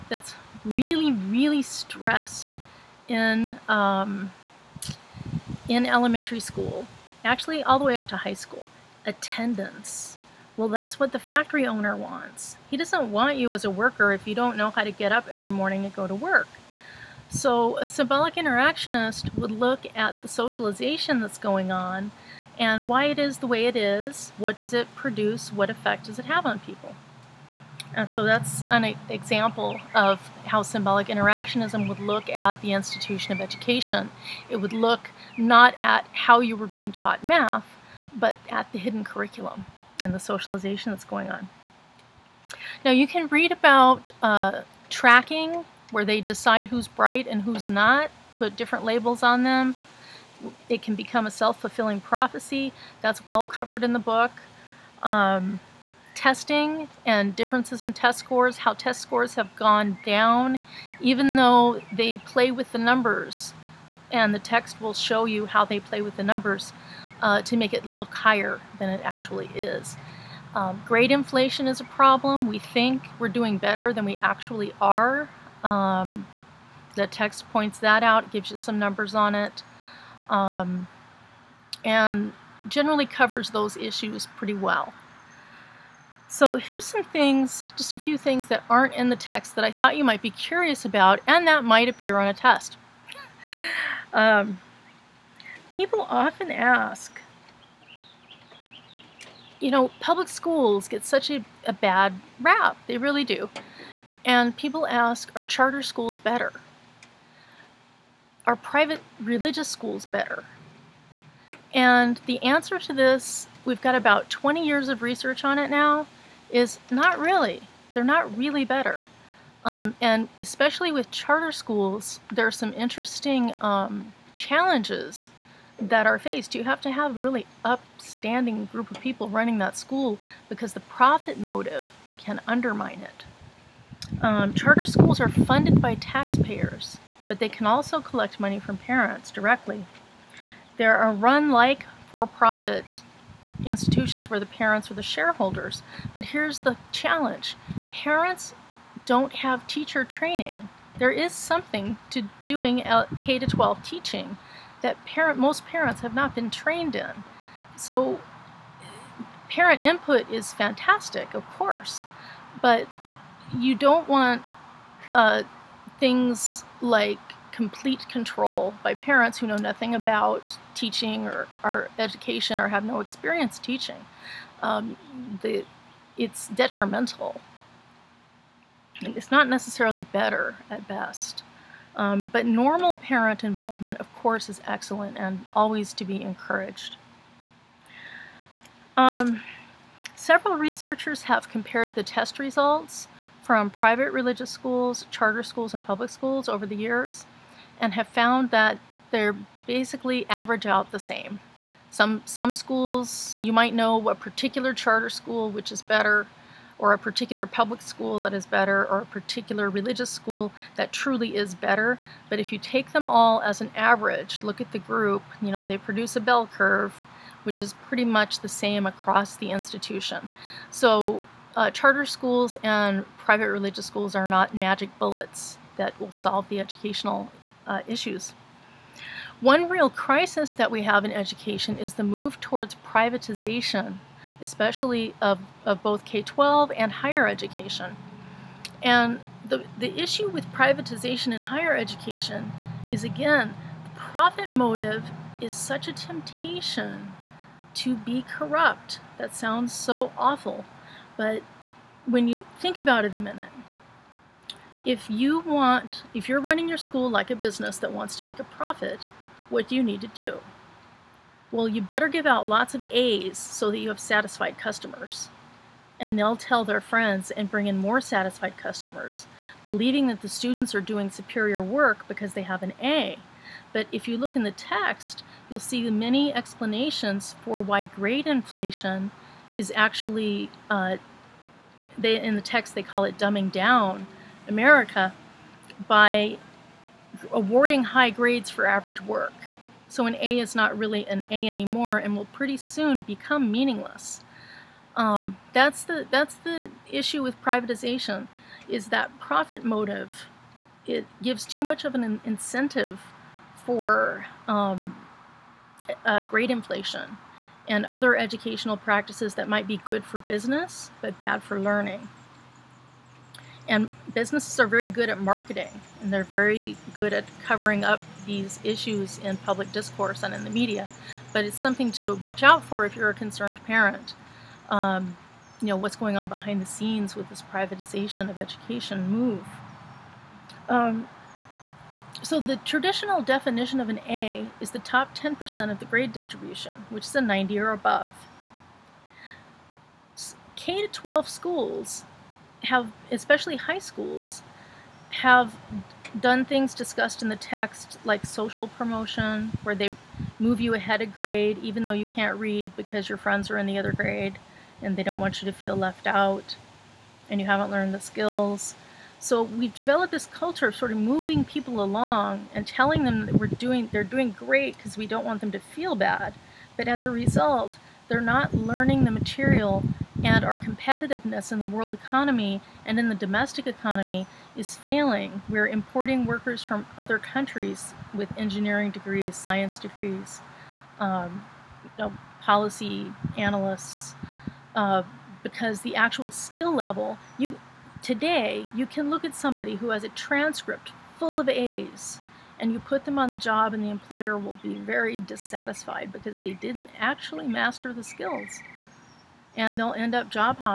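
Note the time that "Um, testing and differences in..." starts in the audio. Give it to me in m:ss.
0:55.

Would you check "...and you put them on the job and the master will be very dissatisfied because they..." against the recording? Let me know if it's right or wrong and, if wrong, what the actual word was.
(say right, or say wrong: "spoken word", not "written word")
wrong: "employer", not "master".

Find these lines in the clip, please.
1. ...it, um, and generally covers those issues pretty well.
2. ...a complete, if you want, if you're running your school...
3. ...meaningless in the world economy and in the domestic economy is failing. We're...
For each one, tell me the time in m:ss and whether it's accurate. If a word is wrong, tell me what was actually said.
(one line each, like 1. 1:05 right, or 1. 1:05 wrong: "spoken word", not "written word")
1. 1:19 right
2. 4:13 wrong: "minute", not "complete"
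3. 6:10 wrong: "competitiveness", not "meaningless".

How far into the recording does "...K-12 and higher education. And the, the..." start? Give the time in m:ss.
3:56.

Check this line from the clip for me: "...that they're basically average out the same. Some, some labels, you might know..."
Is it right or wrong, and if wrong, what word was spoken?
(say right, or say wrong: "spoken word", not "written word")
wrong: "schools", not "labels".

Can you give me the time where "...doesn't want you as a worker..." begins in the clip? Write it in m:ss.
0:12.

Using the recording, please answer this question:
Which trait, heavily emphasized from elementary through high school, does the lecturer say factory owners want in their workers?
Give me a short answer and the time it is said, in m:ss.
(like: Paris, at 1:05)
Attendance, at 0:09.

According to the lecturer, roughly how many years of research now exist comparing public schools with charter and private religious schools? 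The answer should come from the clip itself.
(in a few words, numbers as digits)
20 years.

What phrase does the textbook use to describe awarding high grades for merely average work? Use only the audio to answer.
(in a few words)
Dumbing down America.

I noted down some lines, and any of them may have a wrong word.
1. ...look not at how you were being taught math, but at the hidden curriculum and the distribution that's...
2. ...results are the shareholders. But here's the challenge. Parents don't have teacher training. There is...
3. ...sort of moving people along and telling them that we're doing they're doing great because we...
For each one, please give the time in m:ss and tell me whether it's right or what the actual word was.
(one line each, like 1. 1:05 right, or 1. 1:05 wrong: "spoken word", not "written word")
1. 0:34 wrong: "socialization", not "distribution"
2. 2:24 wrong: "parents", not "results"
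3. 6:00 right.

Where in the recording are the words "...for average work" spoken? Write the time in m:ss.
4:48.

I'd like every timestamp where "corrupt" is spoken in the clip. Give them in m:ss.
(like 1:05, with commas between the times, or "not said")
4:08.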